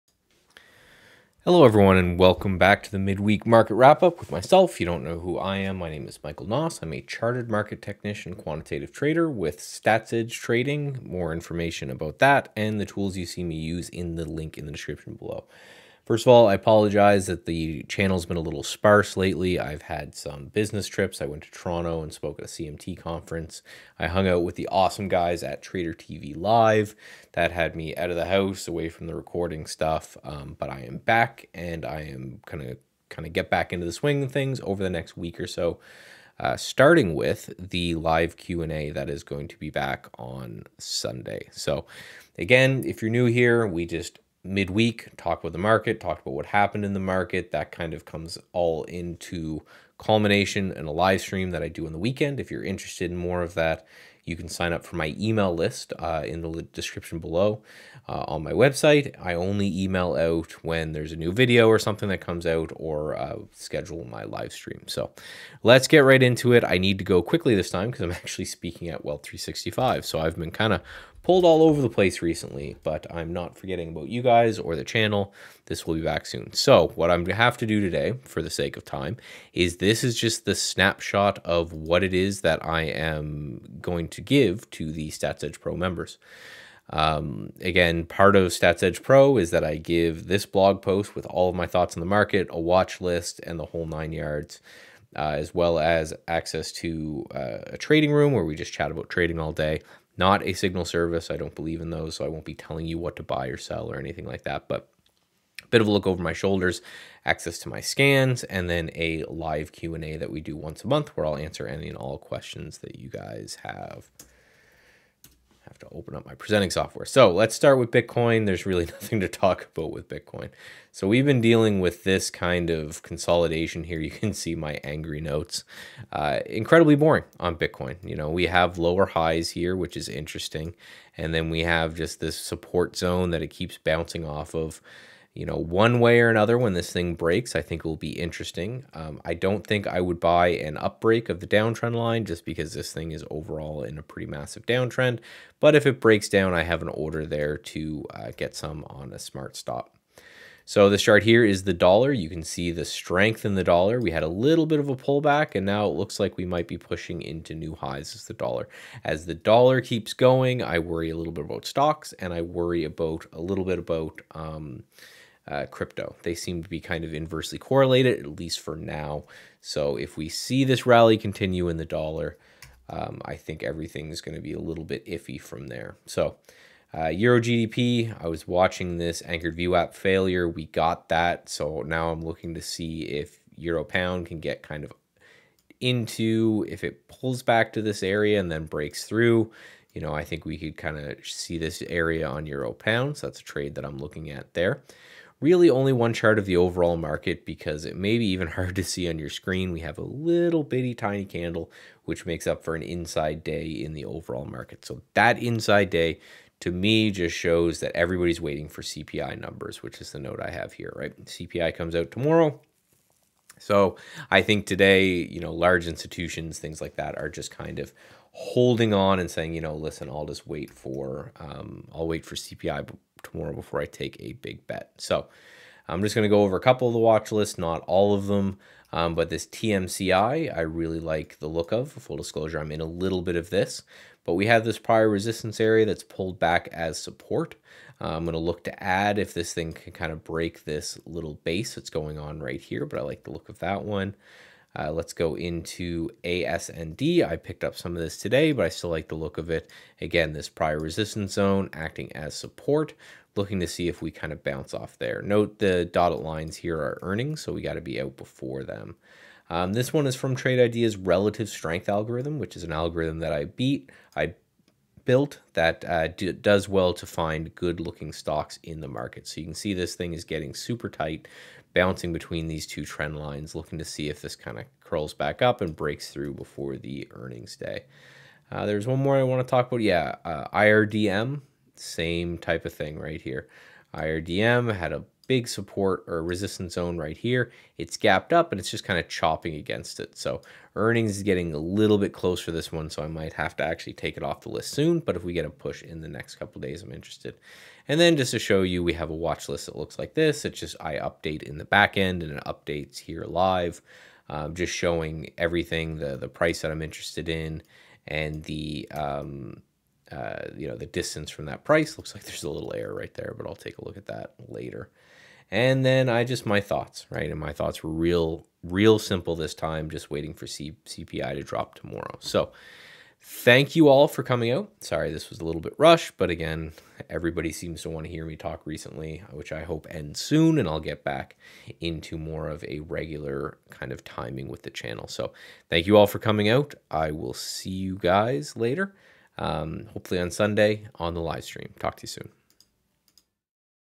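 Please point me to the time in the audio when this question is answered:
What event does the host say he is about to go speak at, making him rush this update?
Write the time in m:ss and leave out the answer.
1:09.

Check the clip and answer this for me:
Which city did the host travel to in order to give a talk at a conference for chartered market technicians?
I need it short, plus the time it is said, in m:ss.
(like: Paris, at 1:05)
Toronto, at 0:21.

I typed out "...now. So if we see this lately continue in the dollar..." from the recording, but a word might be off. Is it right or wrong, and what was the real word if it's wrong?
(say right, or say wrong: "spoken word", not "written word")
wrong: "rally", not "lately".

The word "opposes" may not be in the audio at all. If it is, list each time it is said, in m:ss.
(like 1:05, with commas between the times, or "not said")
not said.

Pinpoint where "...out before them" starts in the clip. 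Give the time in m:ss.
4:17.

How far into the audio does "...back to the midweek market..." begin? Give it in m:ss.
0:02.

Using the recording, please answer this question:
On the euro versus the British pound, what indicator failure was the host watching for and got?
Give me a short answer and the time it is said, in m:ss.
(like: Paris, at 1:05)
anchored VWAP failure, at 2:59.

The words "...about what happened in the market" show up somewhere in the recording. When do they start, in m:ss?
0:46.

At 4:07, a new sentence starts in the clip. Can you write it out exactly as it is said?
I picked up some of this today, but I still like the look of it.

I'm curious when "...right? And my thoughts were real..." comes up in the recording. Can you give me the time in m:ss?
5:17.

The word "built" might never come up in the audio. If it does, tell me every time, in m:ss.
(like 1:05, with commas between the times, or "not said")
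4:25.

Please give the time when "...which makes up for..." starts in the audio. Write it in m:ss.
3:22.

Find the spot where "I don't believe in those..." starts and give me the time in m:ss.
1:41.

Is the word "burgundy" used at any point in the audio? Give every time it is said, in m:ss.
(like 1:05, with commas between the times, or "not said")
not said.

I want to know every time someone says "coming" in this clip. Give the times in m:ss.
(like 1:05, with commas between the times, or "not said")
5:24, 5:36.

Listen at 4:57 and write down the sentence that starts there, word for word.
And then just to show you, we have a watch list that looks like this.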